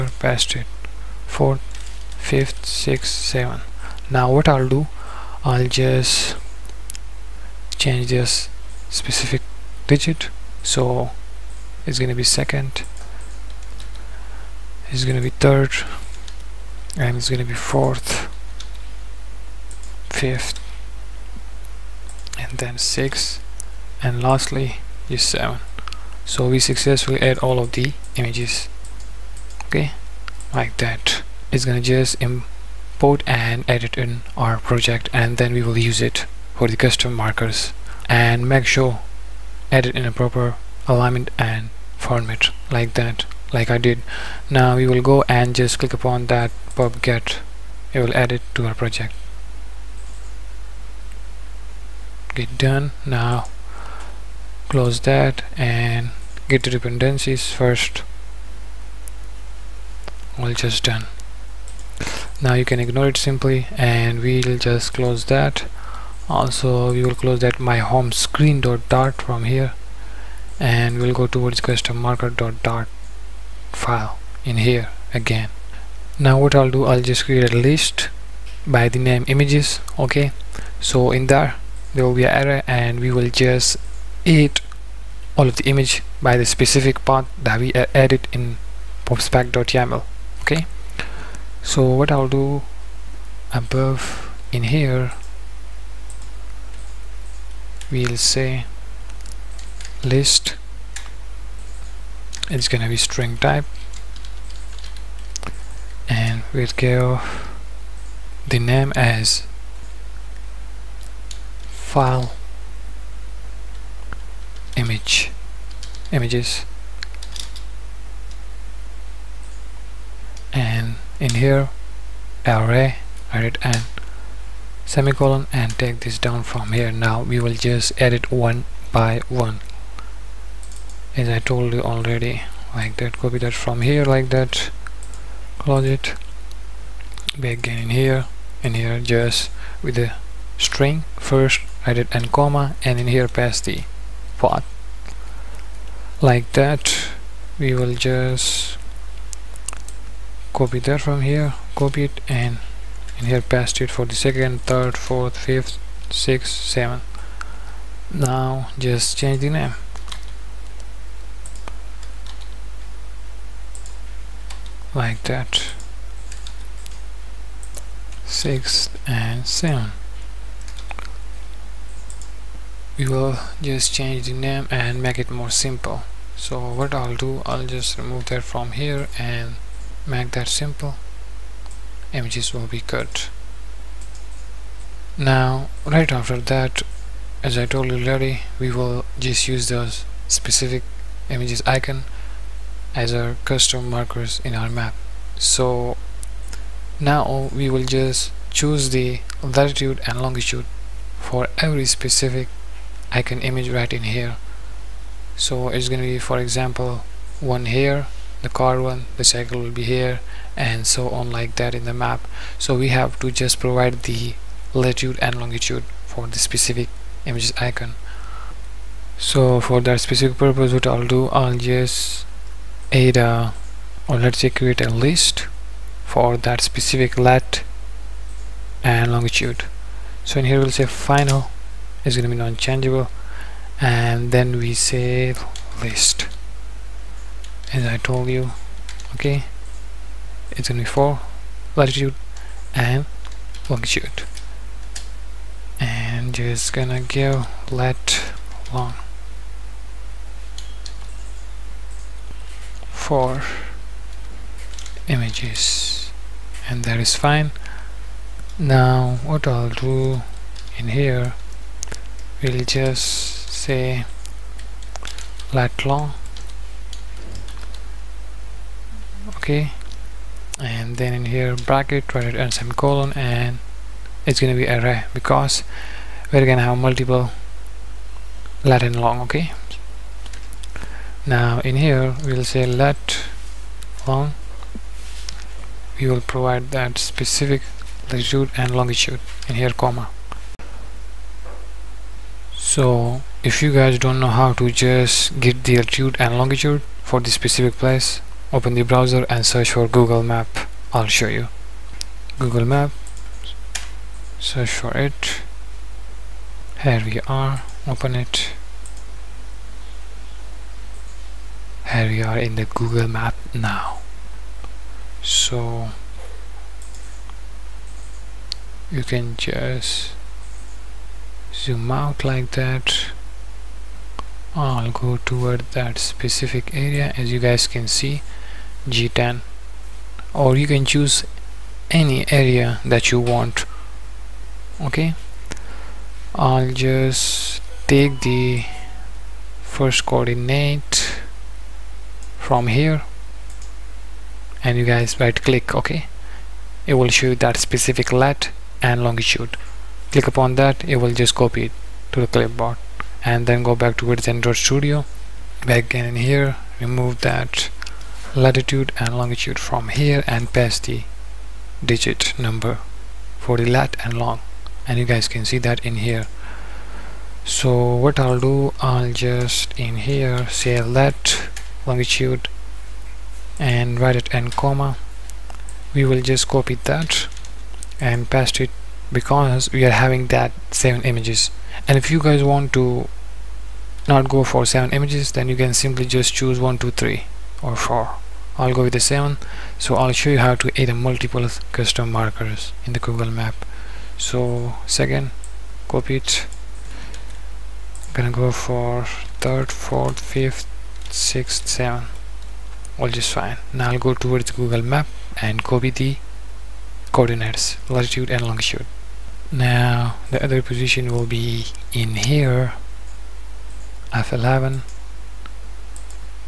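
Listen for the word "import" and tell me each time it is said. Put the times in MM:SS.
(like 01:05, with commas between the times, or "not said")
00:32.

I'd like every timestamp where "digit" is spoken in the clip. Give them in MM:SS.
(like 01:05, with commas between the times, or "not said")
00:09, 06:01.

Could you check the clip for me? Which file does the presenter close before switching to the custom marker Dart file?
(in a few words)
home screen dot dart.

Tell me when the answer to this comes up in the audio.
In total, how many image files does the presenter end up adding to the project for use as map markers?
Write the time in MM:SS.
00:24.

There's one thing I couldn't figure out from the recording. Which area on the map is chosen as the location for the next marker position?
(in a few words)
F11.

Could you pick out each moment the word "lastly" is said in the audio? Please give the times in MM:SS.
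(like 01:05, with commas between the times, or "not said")
00:24.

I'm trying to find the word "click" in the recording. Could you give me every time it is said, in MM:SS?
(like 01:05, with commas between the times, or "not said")
00:45, 00:52, 05:45, 05:50.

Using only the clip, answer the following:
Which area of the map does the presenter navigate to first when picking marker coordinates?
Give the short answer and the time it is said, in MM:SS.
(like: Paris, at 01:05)
G10, at 05:28.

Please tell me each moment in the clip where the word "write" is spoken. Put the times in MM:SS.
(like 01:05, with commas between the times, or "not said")
04:32, 06:13.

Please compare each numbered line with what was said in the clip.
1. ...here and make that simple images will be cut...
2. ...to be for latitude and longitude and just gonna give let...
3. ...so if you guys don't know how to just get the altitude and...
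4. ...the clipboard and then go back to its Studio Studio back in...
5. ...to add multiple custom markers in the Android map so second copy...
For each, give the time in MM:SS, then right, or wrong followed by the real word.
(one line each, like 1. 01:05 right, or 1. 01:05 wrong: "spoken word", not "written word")
1. 02:58 right
2. 04:00 right
3. 04:52 right
4. 05:52 wrong: "Android", not "Studio"
5. 06:30 wrong: "Google", not "Android".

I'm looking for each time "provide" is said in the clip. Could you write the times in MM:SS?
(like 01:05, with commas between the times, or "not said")
03:33, 04:46.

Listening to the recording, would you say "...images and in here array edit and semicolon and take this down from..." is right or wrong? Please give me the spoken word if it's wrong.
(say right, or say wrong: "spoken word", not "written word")
right.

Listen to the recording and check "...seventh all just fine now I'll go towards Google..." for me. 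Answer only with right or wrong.
right.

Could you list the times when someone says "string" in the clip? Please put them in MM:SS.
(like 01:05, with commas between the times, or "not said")
01:42, 02:20.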